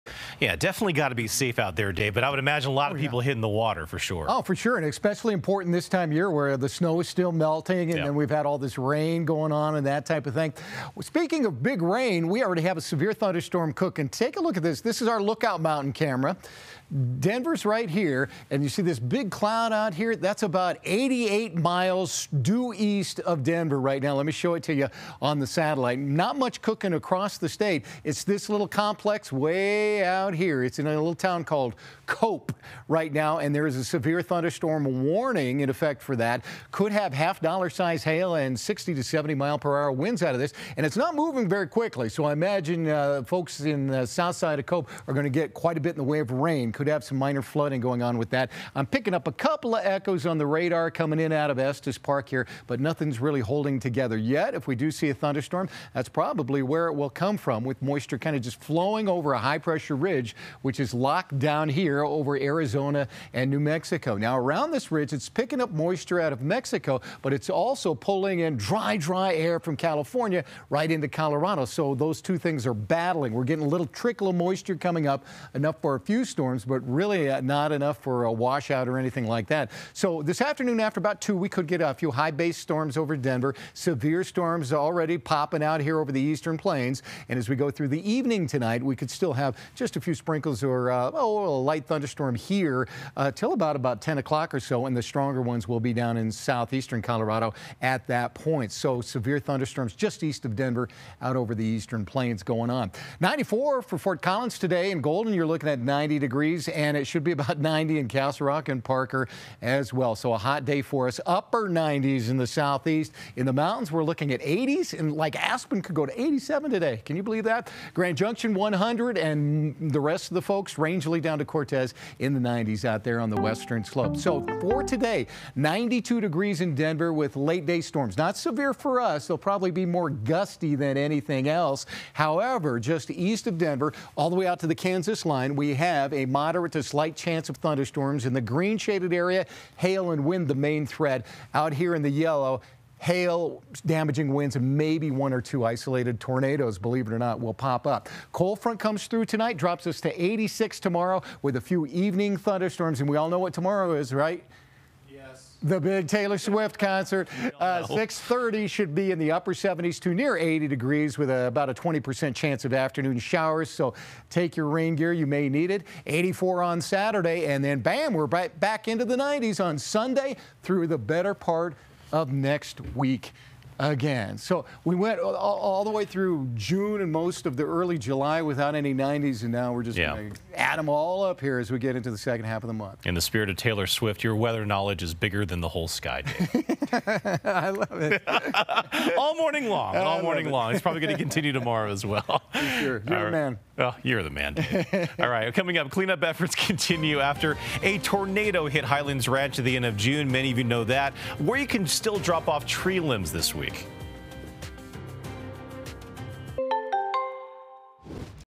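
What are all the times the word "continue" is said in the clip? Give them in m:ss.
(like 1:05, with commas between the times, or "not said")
3:11, 3:16.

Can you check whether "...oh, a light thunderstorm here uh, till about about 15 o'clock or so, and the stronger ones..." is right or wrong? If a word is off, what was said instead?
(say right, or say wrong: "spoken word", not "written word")
wrong: "10", not "15".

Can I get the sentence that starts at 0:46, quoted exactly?
Could have some minor flooding going on with that.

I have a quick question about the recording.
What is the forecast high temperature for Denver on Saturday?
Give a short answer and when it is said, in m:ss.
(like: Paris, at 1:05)
84, at 2:46.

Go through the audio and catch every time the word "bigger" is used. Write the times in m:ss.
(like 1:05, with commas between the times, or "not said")
3:05.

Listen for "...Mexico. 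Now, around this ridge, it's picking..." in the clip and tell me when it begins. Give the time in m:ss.
1:03.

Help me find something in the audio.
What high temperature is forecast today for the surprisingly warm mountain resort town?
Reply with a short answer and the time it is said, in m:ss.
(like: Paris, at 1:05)
87, at 1:56.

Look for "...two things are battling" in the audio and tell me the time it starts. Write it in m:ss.
1:12.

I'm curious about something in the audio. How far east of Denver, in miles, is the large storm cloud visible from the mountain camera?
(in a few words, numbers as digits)
88 miles.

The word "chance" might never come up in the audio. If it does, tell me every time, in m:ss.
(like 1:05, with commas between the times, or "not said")
2:17, 2:42.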